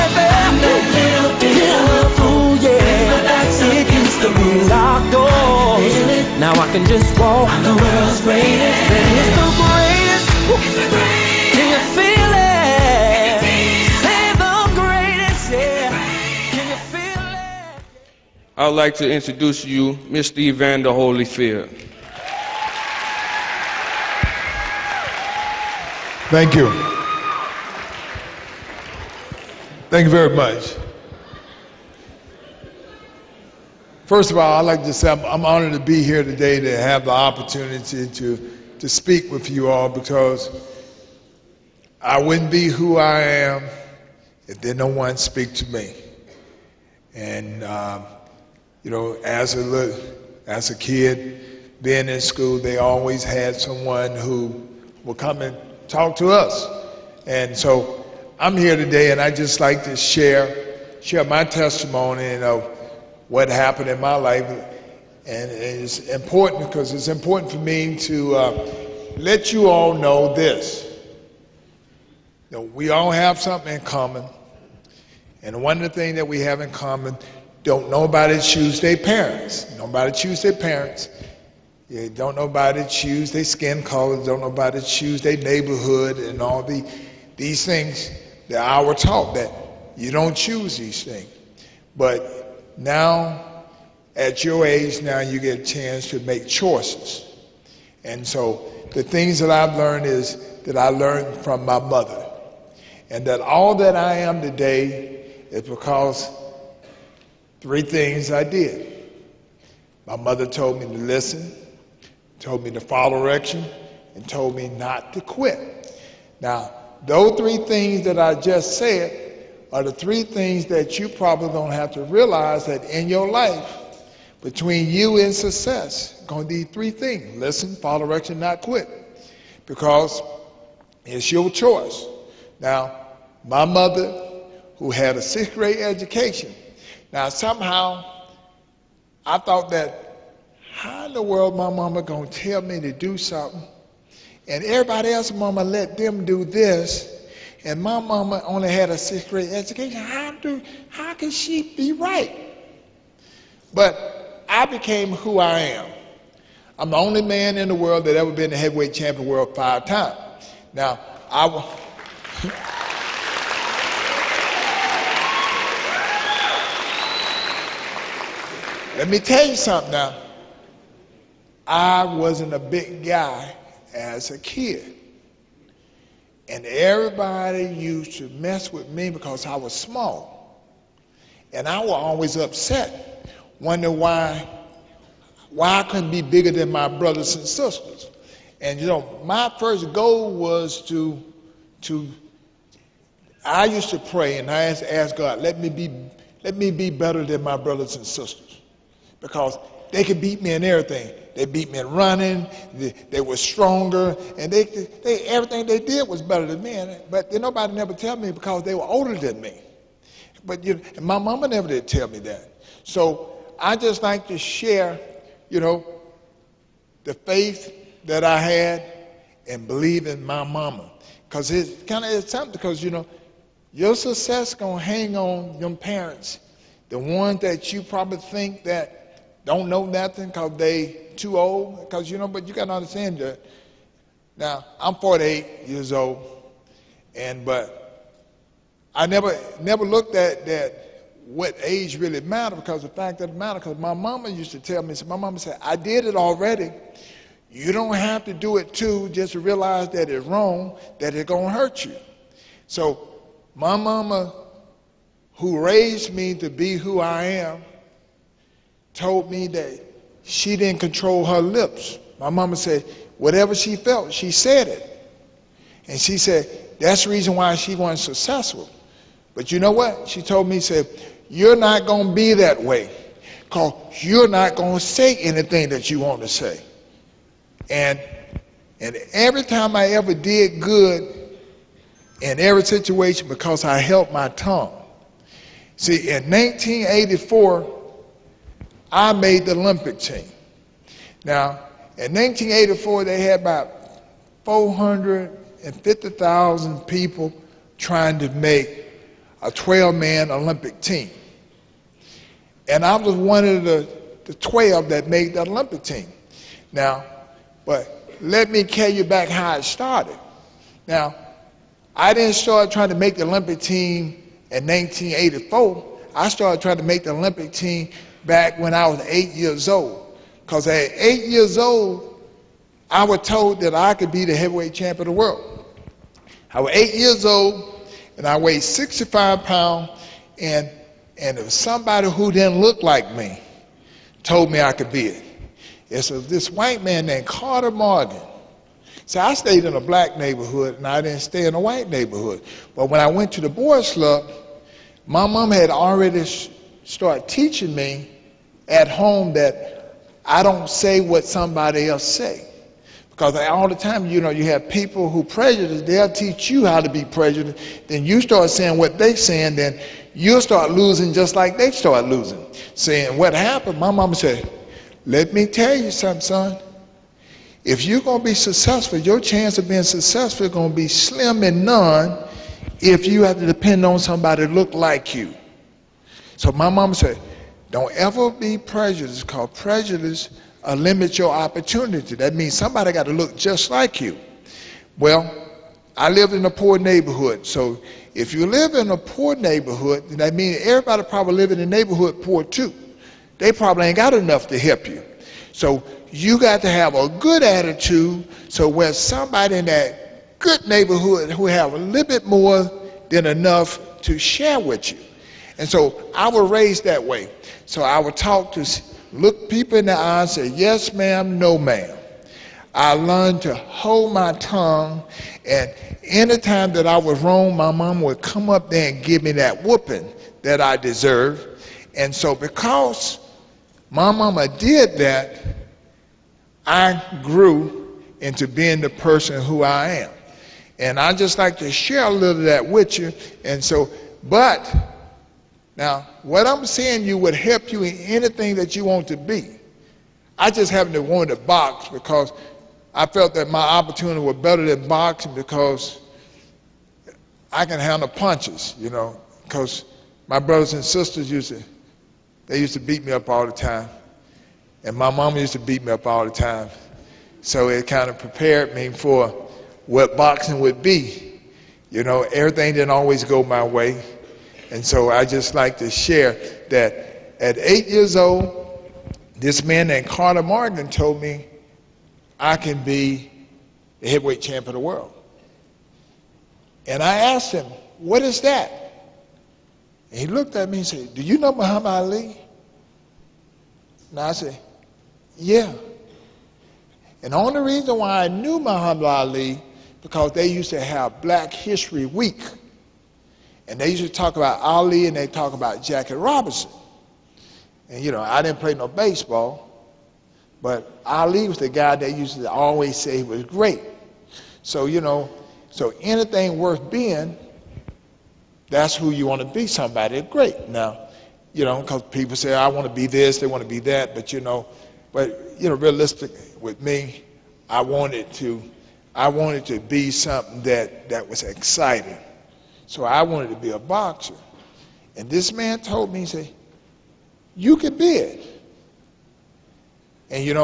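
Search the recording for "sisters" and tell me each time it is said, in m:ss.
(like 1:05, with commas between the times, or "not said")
3:07, 3:18, 7:30.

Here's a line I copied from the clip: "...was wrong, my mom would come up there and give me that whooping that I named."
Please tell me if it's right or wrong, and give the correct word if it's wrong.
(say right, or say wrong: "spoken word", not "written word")
wrong: "deserved", not "named".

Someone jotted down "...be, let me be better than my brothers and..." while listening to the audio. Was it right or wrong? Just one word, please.
right.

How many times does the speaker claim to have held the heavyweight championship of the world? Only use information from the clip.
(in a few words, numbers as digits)
5.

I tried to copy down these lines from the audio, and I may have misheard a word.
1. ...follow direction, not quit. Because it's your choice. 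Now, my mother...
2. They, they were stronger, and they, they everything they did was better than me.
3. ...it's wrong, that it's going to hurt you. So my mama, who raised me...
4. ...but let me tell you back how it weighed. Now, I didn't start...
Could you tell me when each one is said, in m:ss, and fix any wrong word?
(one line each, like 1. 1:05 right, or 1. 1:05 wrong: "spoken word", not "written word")
1. 2:07 right
2. 3:22 right
3. 4:10 right
4. 5:07 wrong: "started", not "weighed".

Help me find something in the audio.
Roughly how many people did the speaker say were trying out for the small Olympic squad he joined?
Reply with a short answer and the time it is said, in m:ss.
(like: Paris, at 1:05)
450,000, at 4:54.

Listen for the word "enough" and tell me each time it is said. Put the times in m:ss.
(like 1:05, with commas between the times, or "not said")
6:34, 6:43.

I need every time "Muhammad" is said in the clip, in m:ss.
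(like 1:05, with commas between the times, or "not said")
8:01, 8:08.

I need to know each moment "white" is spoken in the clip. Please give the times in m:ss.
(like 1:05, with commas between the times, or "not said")
5:36, 5:41.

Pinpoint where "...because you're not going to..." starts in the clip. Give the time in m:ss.
4:33.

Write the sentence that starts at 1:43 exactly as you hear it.
And that all that I am today is because Three things I did.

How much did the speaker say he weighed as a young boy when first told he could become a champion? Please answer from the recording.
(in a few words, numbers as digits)
65 pounds.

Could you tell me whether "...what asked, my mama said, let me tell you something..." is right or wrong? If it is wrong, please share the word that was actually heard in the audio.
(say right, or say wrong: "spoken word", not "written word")
wrong: "happened", not "asked".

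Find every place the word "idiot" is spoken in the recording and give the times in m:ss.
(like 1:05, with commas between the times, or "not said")
not said.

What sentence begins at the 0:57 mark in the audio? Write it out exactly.
And so I'm here today, and I just like to share share my testimony of what happened in my life.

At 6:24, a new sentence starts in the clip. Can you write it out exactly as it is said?
Well, I lived in a poor neighborhood.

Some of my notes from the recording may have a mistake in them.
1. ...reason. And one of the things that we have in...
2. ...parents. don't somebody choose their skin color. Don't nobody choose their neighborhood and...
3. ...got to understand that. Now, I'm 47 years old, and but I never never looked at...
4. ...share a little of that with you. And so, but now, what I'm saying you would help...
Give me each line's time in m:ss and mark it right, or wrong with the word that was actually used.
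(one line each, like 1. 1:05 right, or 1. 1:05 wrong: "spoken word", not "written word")
1. 1:13 wrong: "common", not "reason"
2. 1:20 wrong: "nobody", not "somebody"
3. 3:52 wrong: "48", not "47"
4. 7:11 right.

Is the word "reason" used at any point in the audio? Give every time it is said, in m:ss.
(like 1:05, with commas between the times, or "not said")
4:27, 8:07.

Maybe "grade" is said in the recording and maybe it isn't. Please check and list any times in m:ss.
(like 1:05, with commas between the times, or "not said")
2:15, 2:29.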